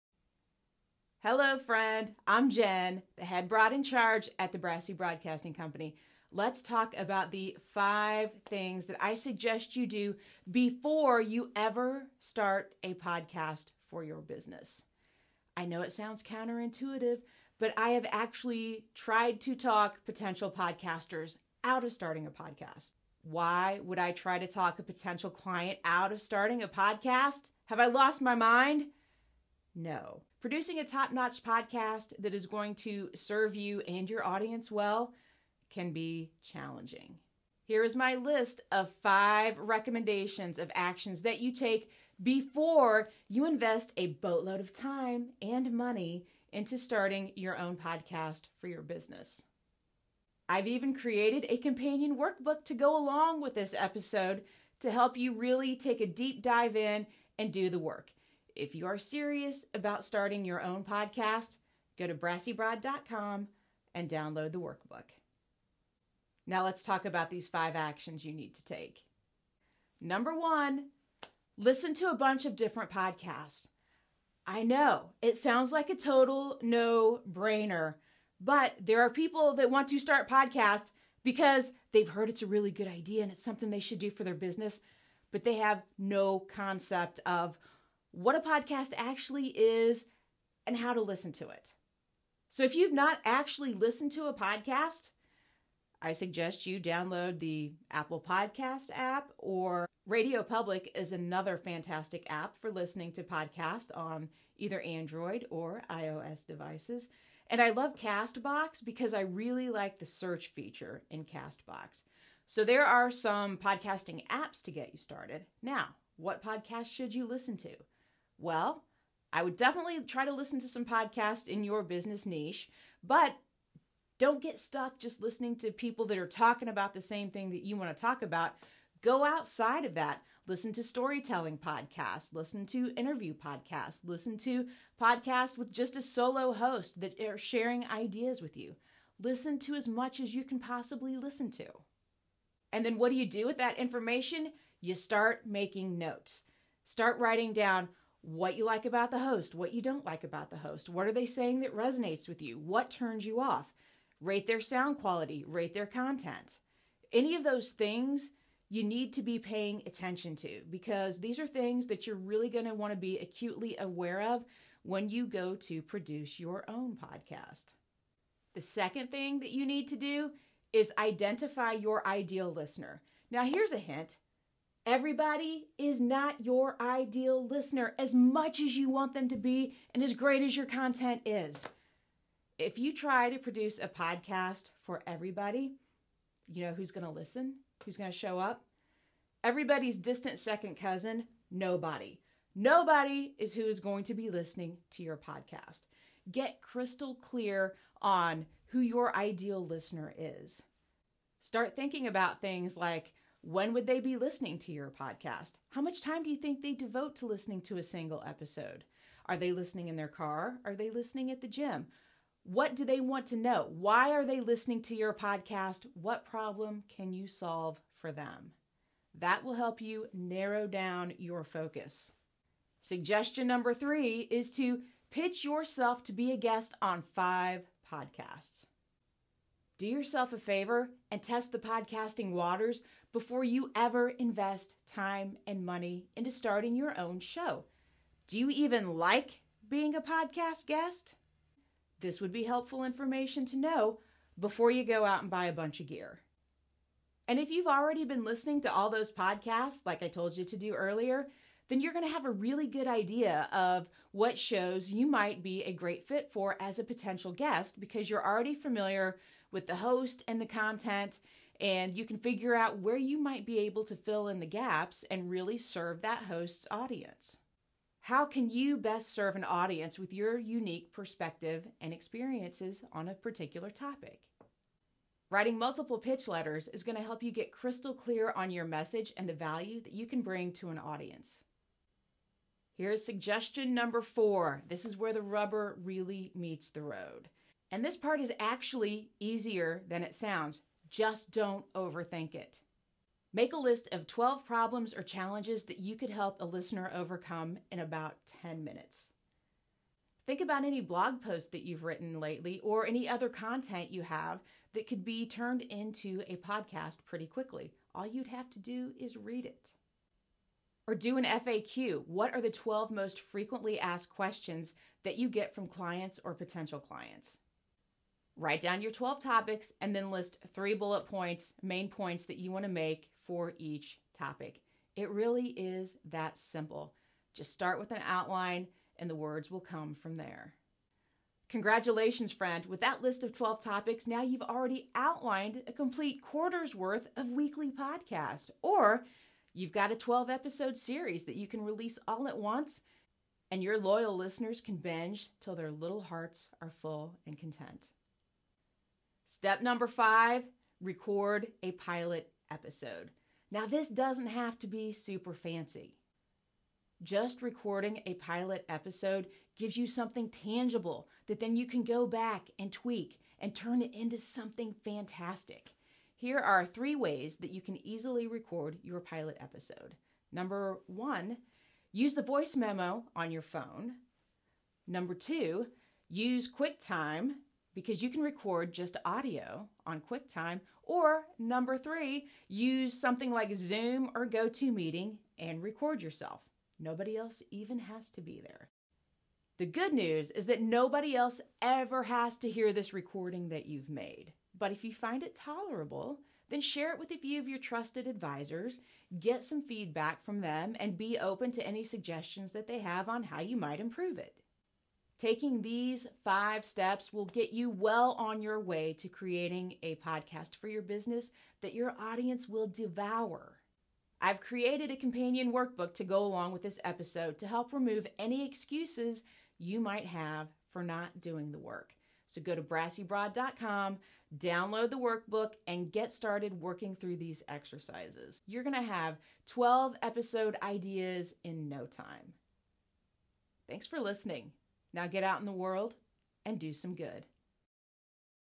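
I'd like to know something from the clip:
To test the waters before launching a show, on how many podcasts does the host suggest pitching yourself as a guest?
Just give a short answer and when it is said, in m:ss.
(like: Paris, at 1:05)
5, at 3:47.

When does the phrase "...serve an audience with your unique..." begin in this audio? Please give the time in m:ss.
4:29.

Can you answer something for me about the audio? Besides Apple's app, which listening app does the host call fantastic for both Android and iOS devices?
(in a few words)
Radio Public.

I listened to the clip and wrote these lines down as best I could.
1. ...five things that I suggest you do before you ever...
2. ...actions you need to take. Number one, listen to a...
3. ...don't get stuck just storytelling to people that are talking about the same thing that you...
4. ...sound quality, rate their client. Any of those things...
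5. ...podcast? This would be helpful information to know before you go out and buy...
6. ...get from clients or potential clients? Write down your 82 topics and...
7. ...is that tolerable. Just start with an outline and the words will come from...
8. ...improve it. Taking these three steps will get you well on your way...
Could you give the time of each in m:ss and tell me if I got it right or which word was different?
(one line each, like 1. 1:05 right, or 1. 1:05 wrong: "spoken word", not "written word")
1. 0:07 right
2. 1:07 right
3. 2:04 wrong: "listening", not "storytelling"
4. 2:34 wrong: "content", not "client"
5. 4:00 wrong: "guest", not "podcast"
6. 5:15 wrong: "12", not "82"
7. 5:25 wrong: "simple", not "tolerable"
8. 6:43 wrong: "five", not "three".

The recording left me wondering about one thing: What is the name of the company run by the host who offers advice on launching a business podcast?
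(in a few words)
Brassy Broadcasting Company.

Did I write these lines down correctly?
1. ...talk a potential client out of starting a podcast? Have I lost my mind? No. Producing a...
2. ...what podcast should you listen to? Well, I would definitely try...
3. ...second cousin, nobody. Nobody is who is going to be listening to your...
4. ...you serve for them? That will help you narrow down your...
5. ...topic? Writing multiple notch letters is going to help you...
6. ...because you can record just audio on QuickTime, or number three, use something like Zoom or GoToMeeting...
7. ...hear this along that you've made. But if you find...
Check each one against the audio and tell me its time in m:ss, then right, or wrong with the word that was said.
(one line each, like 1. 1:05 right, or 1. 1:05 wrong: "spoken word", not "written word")
1. 0:24 right
2. 1:56 right
3. 3:10 right
4. 3:37 wrong: "solve", not "serve"
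5. 4:33 wrong: "pitch", not "notch"
6. 6:17 right
7. 6:32 wrong: "recording", not "along".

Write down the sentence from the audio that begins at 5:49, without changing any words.
Step number five record a pilot episode.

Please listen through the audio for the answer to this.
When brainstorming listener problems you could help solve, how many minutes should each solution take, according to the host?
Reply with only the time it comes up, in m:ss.
4:58.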